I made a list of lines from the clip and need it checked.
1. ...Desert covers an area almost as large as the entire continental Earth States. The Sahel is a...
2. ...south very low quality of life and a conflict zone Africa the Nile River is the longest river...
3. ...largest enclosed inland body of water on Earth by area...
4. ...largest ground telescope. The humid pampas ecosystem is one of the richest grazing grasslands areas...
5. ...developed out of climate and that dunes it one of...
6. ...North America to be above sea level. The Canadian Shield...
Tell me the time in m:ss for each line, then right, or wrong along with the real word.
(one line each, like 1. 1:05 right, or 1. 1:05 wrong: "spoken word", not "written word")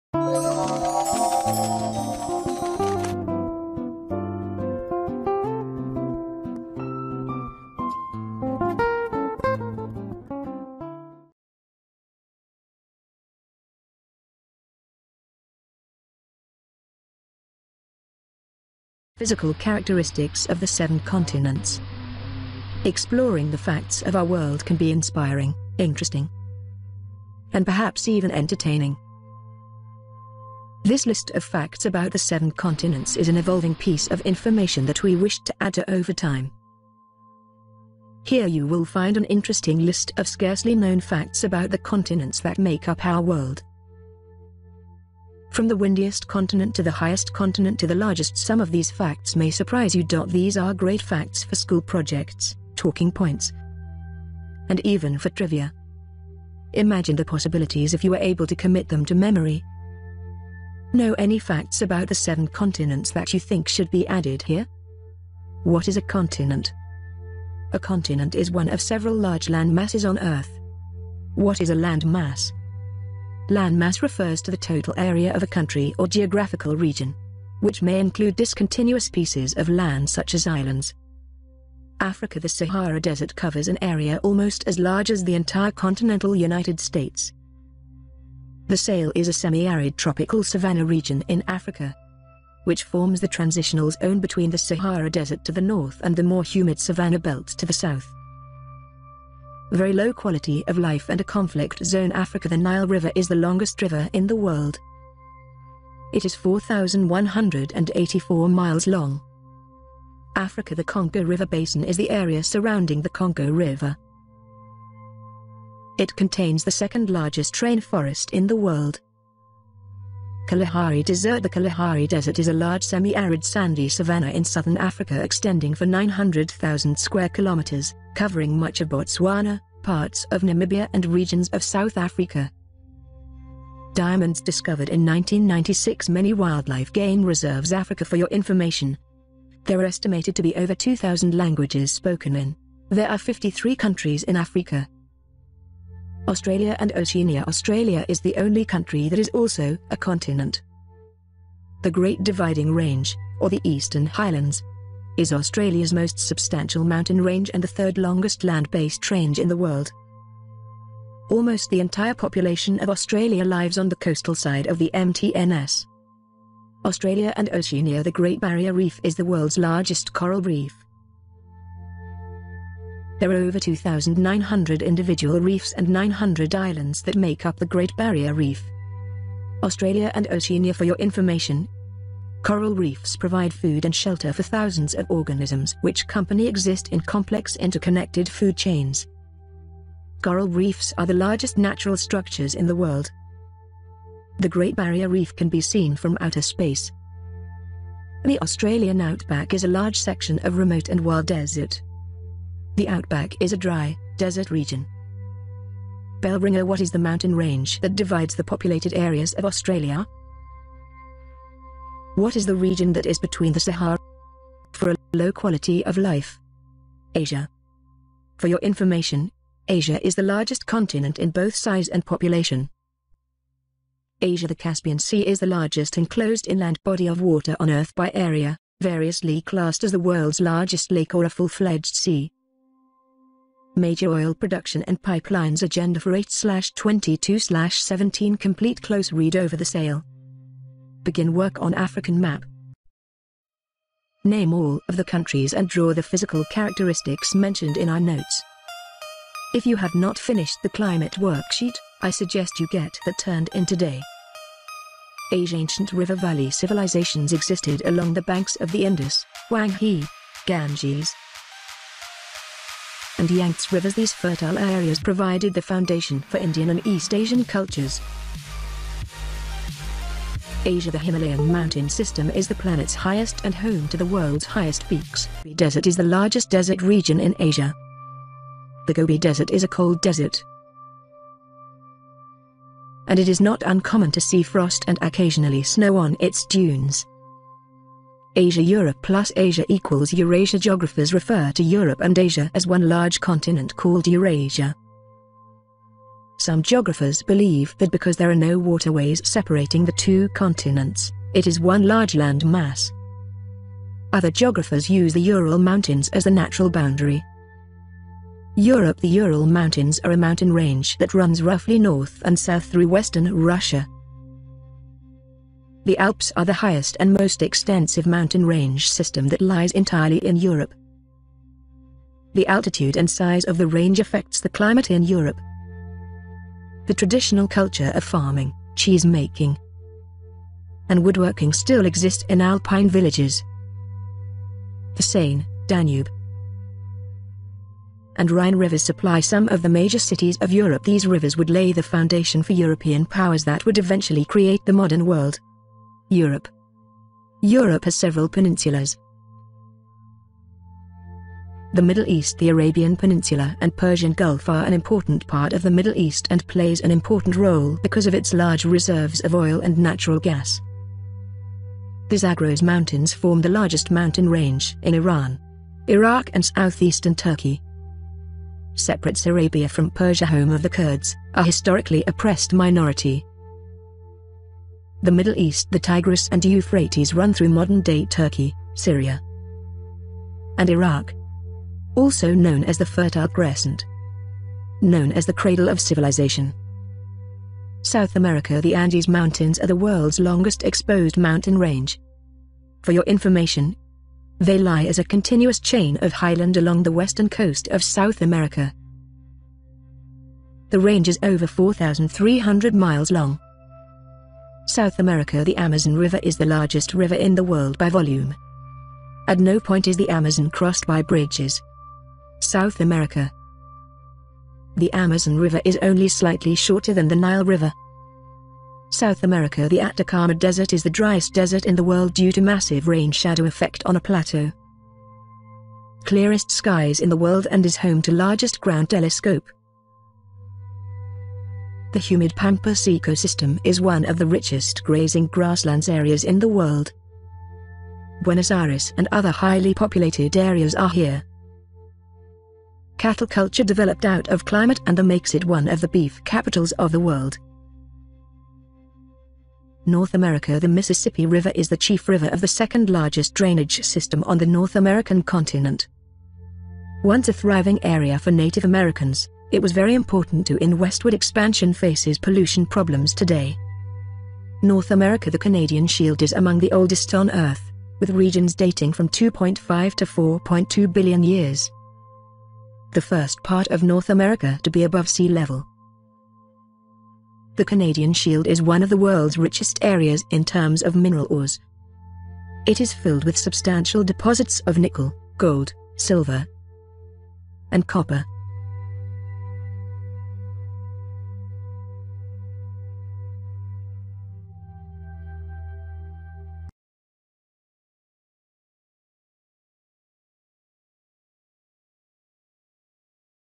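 1. 1:22 wrong: "United", not "Earth"
2. 1:37 right
3. 3:45 right
4. 7:08 right
5. 7:23 wrong: "makes", not "dunes"
6. 7:53 right.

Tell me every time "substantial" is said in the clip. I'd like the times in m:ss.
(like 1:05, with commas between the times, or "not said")
2:36, 8:03.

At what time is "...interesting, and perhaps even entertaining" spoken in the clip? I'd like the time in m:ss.
0:25.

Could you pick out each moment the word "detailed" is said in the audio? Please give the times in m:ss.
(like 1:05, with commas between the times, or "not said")
not said.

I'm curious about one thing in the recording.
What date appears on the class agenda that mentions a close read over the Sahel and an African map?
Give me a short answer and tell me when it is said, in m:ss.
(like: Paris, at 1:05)
8-22-17, at 3:56.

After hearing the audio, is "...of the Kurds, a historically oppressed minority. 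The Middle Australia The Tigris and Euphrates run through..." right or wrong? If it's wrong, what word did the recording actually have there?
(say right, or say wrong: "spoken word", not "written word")
wrong: "East", not "Australia".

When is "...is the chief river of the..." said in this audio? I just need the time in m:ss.
7:31.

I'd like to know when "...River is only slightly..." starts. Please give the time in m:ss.
6:55.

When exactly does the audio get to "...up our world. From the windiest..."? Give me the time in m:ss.
0:42.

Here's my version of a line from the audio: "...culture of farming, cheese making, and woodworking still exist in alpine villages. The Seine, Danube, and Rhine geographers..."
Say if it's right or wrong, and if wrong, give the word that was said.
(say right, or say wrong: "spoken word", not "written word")
wrong: "rivers", not "geographers".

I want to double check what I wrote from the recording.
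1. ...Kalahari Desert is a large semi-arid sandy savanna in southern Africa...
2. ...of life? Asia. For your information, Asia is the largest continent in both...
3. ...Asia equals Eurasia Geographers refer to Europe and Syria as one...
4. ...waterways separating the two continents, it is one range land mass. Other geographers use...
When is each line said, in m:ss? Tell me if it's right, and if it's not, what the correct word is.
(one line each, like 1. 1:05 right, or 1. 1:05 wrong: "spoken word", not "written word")
1. 2:01 right
2. 3:35 right
3. 4:49 wrong: "Asia", not "Syria"
4. 4:58 wrong: "large", not "range".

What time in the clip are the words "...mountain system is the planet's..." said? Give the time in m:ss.
4:31.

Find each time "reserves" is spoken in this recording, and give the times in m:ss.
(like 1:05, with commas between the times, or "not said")
2:17, 5:58.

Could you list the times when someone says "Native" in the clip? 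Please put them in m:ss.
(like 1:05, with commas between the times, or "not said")
7:38.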